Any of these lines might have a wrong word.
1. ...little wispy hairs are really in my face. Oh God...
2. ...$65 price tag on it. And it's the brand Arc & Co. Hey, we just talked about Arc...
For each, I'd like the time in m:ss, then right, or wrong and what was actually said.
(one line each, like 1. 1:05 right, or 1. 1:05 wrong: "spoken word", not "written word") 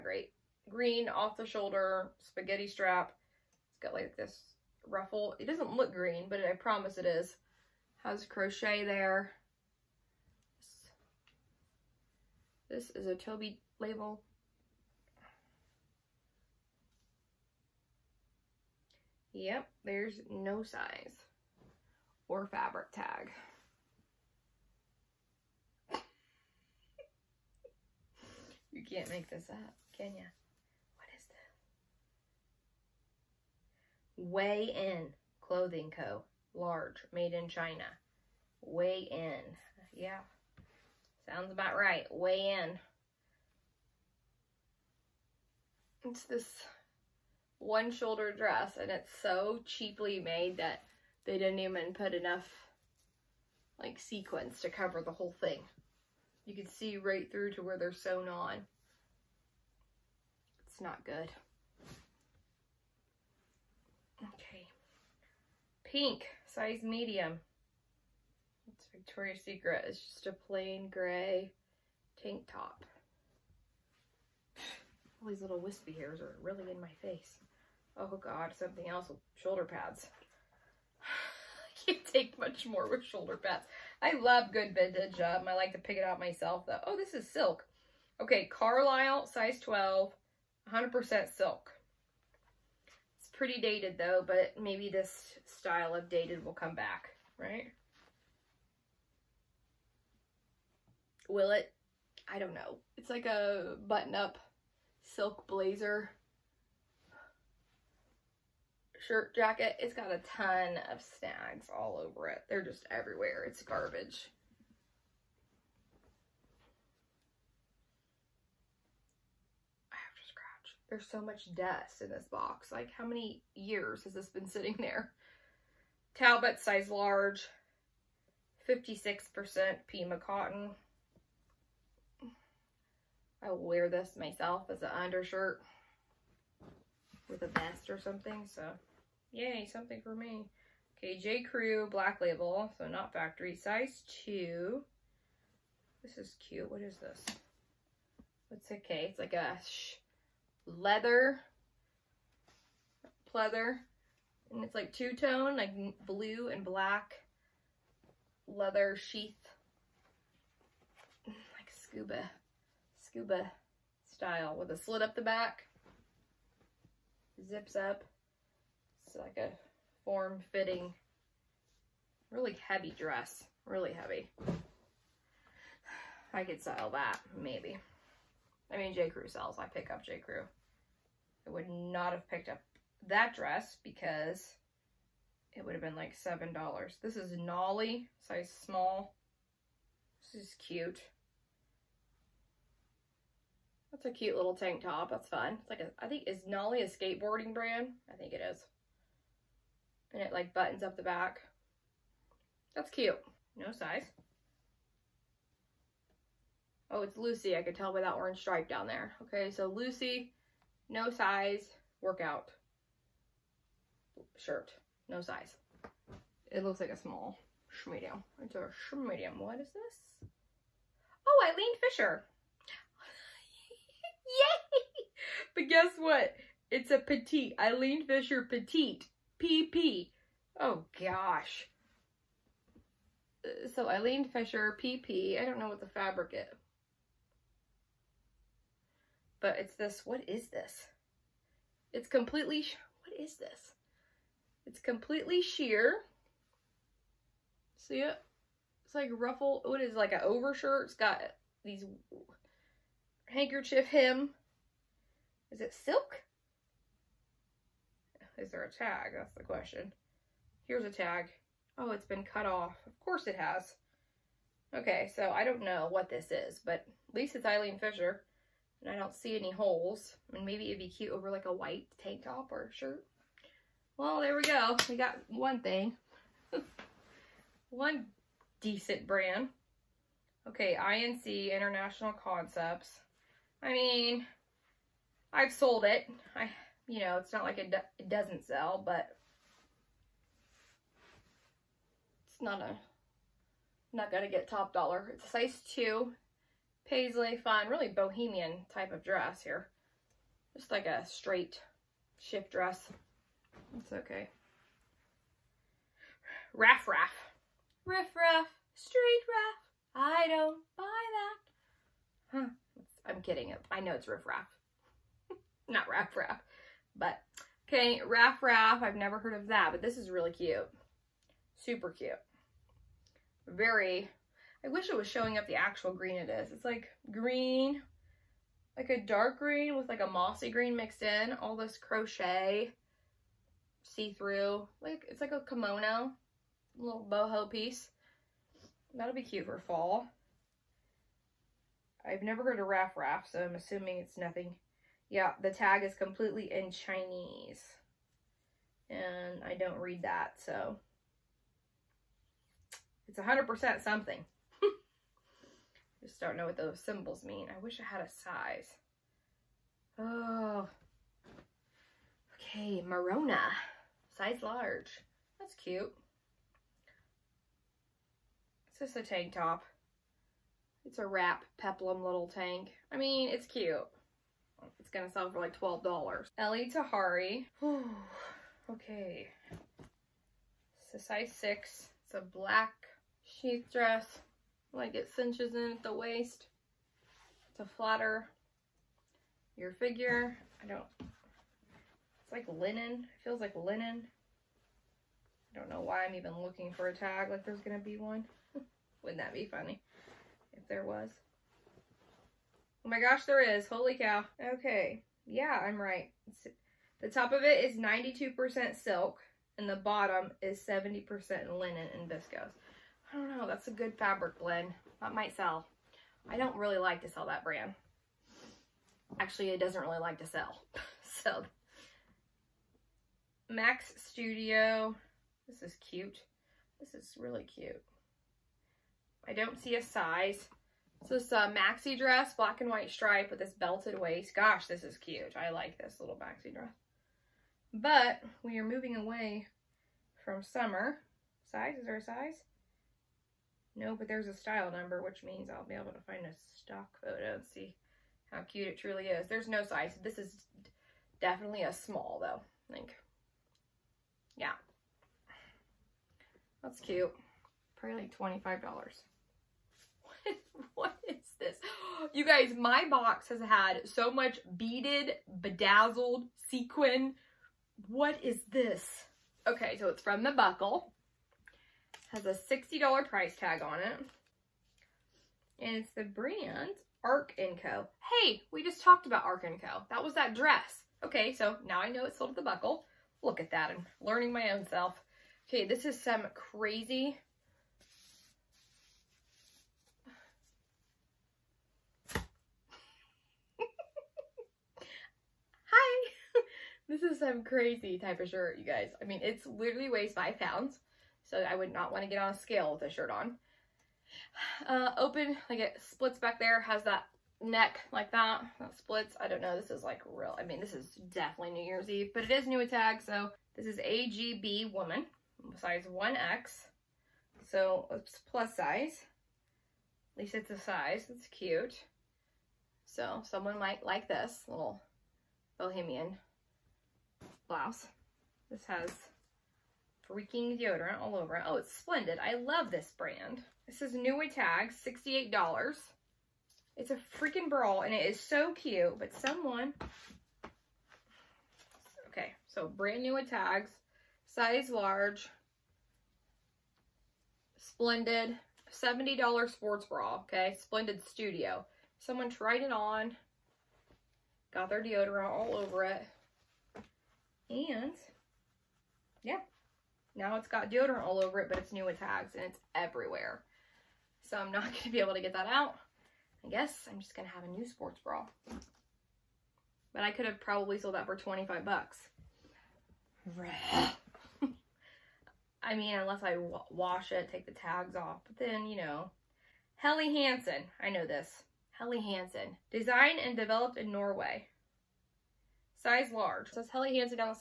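1. 1:15 right
2. 7:52 wrong: "60", not "65".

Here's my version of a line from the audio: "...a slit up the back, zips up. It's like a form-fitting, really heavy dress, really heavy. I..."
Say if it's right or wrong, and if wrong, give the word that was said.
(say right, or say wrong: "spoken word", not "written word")
right.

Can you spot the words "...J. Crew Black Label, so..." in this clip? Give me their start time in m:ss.
2:21.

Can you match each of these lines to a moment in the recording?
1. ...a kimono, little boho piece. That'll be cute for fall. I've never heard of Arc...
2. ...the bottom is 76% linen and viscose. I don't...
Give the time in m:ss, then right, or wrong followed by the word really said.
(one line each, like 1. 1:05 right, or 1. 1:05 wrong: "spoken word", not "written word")
1. 5:35 wrong: "Raff", not "Arc"
2. 6:49 wrong: "70", not "76".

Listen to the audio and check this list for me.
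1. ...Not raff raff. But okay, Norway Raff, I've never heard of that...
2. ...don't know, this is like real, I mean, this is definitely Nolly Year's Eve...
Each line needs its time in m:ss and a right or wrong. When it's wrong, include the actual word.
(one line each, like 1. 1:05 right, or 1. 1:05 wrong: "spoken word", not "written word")
1. 5:15 wrong: "Raff", not "Norway"
2. 8:29 wrong: "New", not "Nolly".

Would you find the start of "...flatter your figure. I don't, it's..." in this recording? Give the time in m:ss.
6:27.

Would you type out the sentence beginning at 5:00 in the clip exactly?
Just like a straight shift dress.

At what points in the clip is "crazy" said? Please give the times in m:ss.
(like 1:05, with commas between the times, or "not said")
8:06, 8:17.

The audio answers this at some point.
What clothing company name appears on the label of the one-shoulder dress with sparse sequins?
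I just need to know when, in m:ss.
0:34.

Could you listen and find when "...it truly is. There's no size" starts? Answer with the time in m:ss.
7:28.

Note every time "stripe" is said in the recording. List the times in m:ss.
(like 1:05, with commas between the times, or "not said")
3:28, 7:12.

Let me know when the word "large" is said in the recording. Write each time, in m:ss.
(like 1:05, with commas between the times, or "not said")
0:36, 2:06, 6:04, 9:04, 9:46.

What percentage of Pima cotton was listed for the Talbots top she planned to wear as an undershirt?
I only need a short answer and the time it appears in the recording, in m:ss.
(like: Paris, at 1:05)
56%, at 2:08.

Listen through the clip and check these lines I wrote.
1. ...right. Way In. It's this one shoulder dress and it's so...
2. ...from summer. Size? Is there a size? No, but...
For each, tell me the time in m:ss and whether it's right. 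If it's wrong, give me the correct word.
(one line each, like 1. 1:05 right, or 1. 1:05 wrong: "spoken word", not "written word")
1. 0:41 right
2. 7:20 right.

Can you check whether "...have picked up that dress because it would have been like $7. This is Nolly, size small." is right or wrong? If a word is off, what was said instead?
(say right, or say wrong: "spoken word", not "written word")
right.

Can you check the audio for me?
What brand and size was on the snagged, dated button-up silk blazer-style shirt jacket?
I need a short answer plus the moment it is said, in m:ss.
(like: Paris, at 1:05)
Carlisle, size 12, at 1:28.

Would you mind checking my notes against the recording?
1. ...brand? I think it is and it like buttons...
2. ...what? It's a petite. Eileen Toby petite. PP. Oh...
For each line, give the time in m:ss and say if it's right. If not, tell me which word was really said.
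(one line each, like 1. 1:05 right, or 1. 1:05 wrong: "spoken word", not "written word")
1. 3:17 right
2. 3:45 wrong: "Fisher", not "Toby".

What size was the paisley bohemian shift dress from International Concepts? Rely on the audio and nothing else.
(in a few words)
2.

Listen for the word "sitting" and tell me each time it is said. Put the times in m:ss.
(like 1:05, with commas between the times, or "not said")
2:04.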